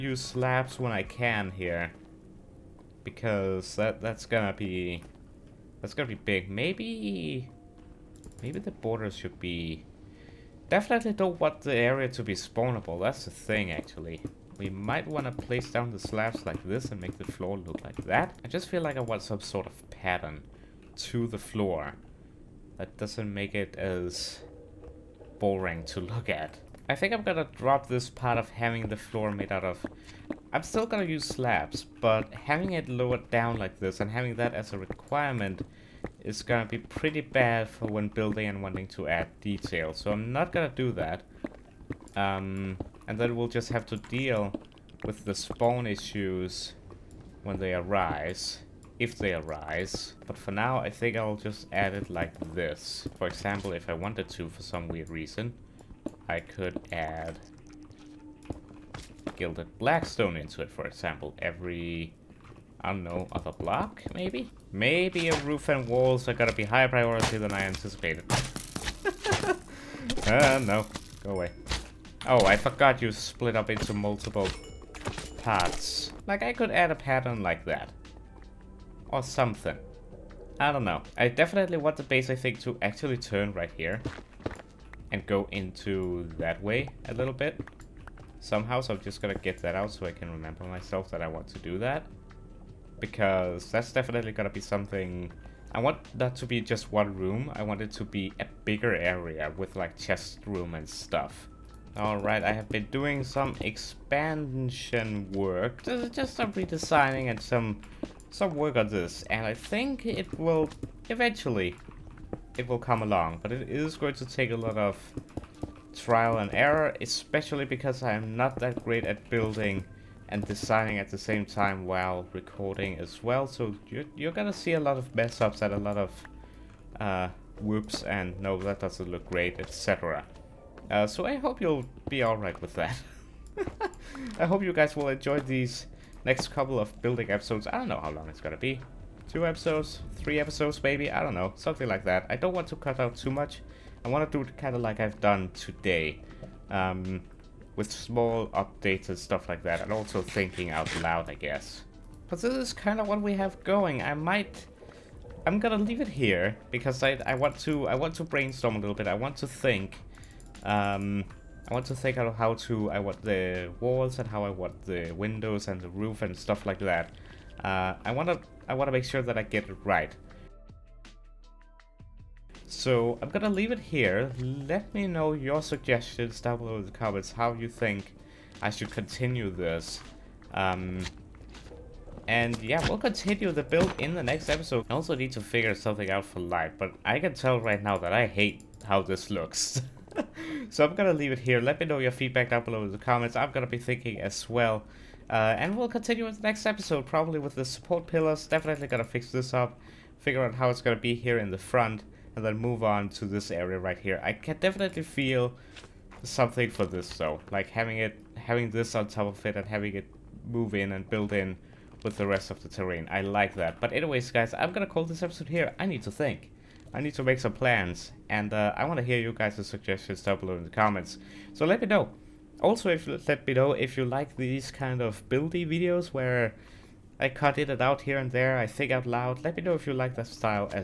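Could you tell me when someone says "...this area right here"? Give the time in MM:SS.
03:23.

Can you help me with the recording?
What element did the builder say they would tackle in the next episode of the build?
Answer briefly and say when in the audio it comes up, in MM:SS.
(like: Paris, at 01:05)
Support pillars, at 03:17.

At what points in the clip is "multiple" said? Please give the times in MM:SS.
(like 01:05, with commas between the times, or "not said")
01:13.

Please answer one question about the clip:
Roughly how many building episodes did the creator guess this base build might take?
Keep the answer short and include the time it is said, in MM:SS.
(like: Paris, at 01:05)
2 or 3, at 02:19.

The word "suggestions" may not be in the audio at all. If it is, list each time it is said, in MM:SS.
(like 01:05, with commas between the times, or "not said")
02:55, 03:39.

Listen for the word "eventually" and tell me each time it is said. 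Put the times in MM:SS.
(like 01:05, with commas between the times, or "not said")
01:51.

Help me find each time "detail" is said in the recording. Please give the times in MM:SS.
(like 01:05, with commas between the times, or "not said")
00:39.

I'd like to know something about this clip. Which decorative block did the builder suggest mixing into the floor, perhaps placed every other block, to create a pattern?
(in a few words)
Gilded blackstone.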